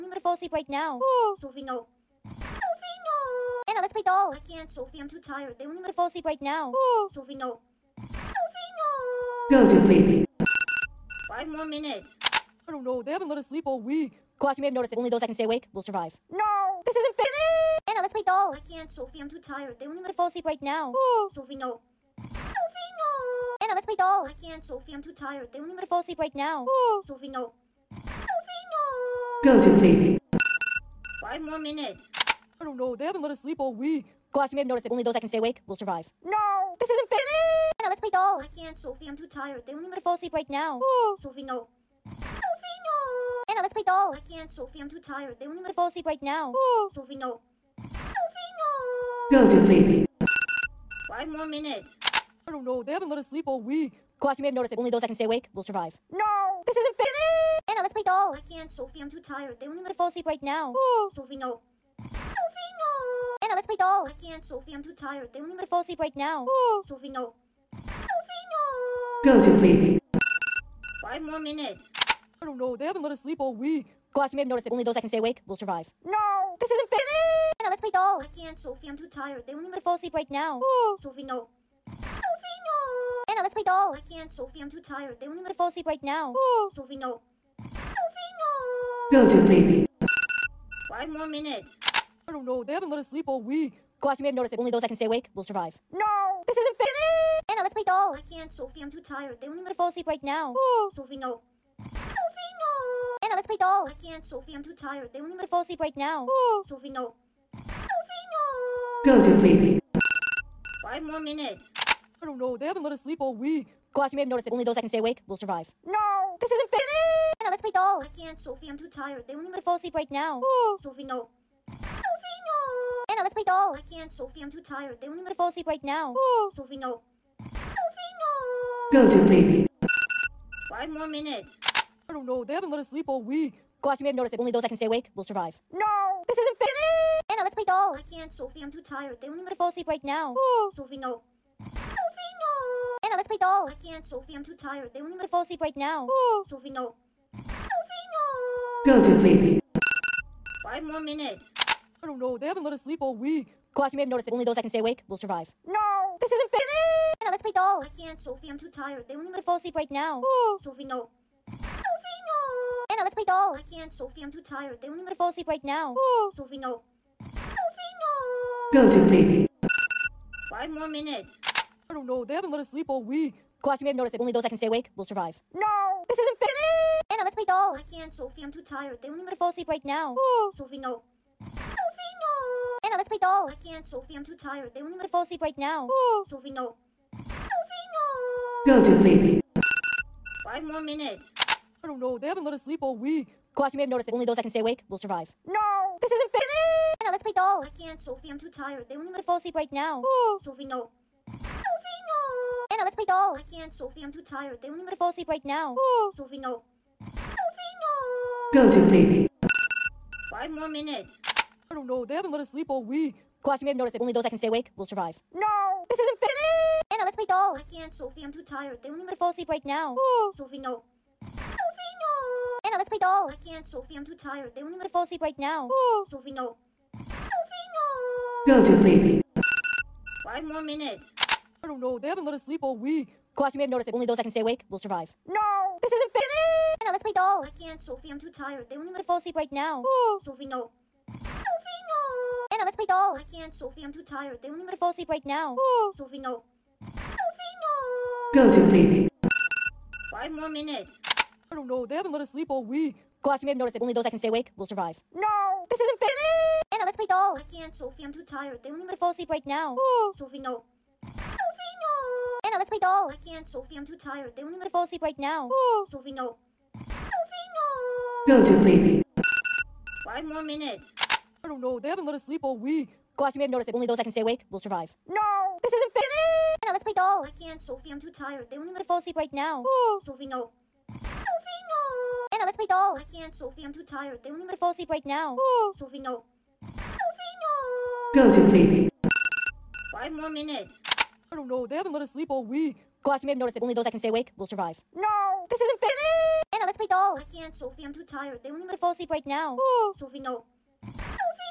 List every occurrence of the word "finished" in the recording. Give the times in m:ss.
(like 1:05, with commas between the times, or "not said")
2:16.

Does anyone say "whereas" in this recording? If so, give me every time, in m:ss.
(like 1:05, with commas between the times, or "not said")
not said.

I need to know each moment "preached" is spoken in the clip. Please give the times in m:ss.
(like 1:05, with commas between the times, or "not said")
not said.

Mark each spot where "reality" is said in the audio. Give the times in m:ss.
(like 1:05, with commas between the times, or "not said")
not said.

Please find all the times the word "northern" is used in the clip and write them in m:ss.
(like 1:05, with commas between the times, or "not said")
not said.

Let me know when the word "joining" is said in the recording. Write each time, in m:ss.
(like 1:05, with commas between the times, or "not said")
not said.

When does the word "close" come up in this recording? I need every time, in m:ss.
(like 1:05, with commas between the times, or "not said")
not said.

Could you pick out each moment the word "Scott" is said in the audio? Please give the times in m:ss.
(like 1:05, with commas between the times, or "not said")
not said.